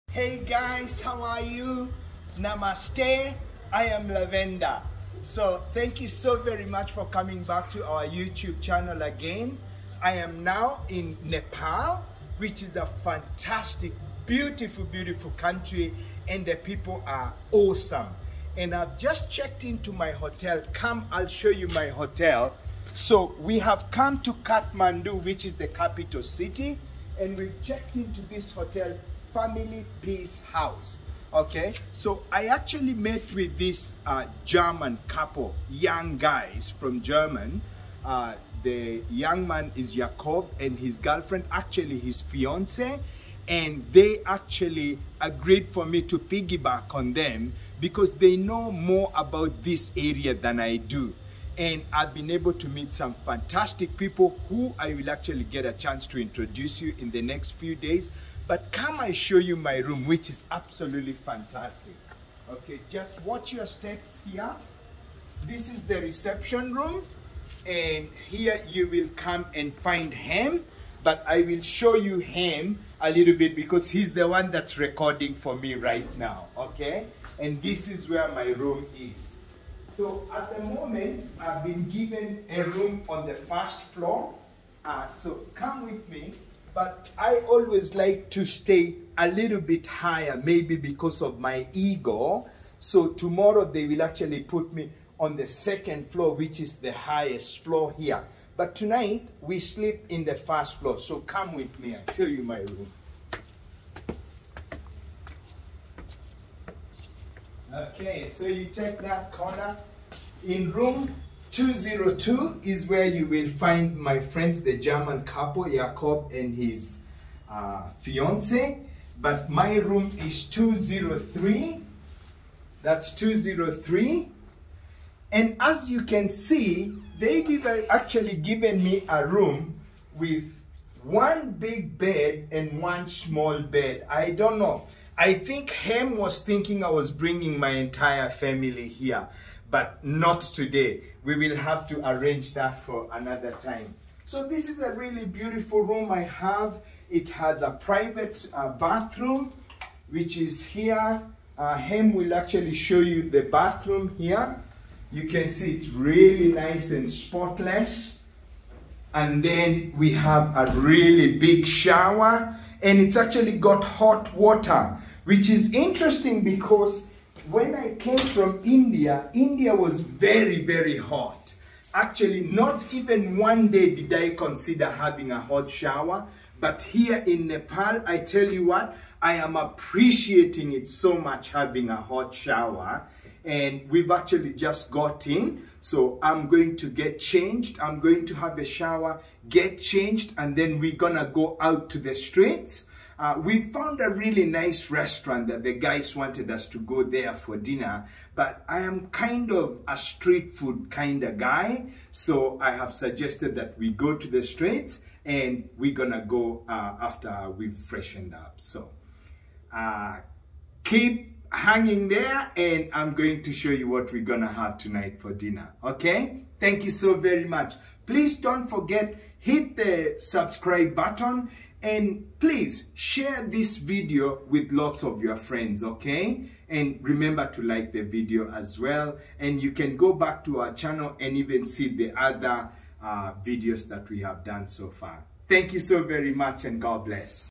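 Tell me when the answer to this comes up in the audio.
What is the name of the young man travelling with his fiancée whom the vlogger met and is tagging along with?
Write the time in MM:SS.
00:39.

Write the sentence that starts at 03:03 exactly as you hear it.
And we've actually just got in.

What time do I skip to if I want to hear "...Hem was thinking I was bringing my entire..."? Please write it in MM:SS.
02:15.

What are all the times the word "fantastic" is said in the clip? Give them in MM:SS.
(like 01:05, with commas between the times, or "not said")
00:12, 00:53, 01:01.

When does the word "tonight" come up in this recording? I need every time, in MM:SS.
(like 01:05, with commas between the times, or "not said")
01:38, 03:34.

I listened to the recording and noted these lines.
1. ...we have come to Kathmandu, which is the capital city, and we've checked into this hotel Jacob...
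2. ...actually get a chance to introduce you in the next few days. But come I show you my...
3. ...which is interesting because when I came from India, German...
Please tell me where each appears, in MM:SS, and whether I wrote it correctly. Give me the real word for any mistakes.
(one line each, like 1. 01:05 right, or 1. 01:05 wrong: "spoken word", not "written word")
1. 00:23 wrong: "Family", not "Jacob"
2. 00:55 right
3. 02:45 wrong: "India", not "German".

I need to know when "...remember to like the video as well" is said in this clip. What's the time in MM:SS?
03:47.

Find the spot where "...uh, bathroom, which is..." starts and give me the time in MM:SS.
02:28.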